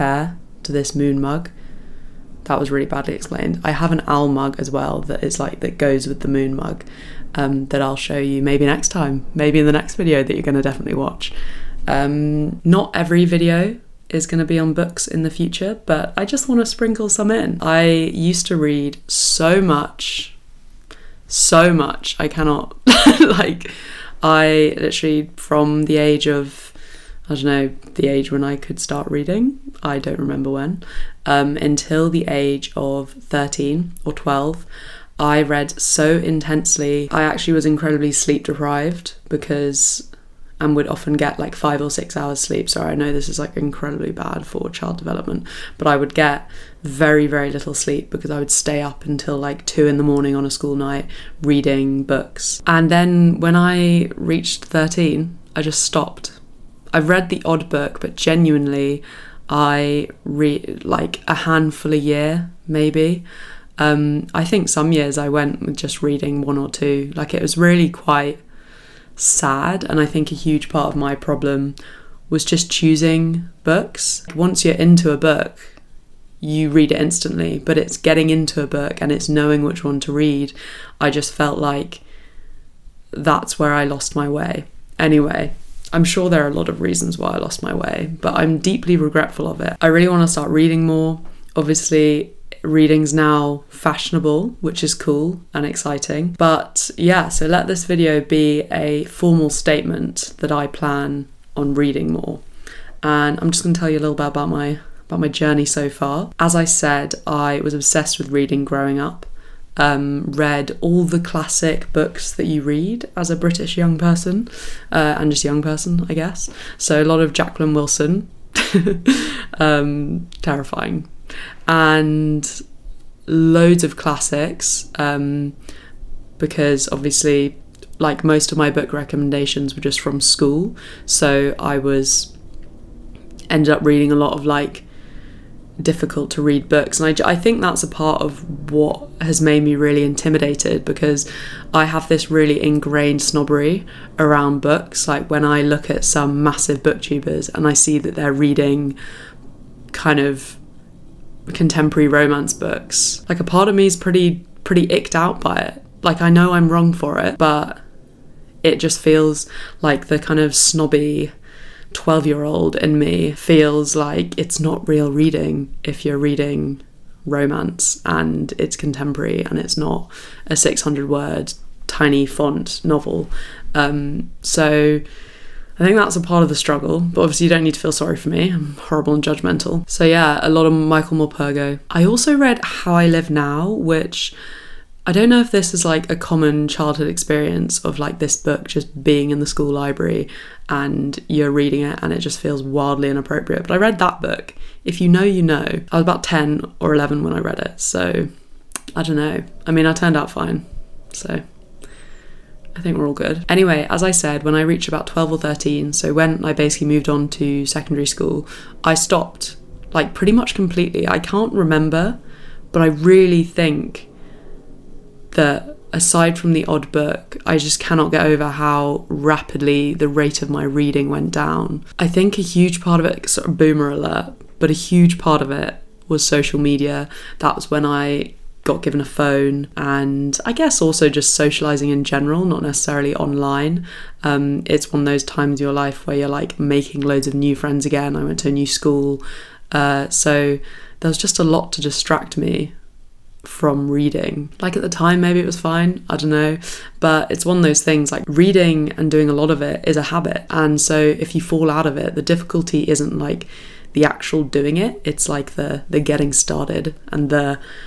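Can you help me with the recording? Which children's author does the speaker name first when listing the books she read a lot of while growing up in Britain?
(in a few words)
Jacqueline Wilson.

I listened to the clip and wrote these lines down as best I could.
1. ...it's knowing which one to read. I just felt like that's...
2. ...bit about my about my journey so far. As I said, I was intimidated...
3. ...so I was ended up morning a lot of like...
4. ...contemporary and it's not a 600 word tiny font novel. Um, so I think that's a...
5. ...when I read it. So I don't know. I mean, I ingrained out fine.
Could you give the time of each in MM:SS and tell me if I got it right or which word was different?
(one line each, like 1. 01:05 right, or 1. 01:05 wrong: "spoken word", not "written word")
1. 01:19 right
2. 01:44 wrong: "obsessed", not "intimidated"
3. 02:11 wrong: "reading", not "morning"
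4. 02:48 right
5. 03:17 wrong: "turned", not "ingrained".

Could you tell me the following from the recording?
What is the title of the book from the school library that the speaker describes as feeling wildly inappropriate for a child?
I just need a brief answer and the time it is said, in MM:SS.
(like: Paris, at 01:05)
How I Live Now, at 03:02.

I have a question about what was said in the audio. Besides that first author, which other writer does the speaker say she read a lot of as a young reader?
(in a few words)
Michael Morpurgo.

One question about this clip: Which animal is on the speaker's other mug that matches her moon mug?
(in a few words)
Owl.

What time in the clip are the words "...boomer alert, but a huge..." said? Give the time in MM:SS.
03:43.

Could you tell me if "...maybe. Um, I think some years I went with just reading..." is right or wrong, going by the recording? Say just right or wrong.
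right.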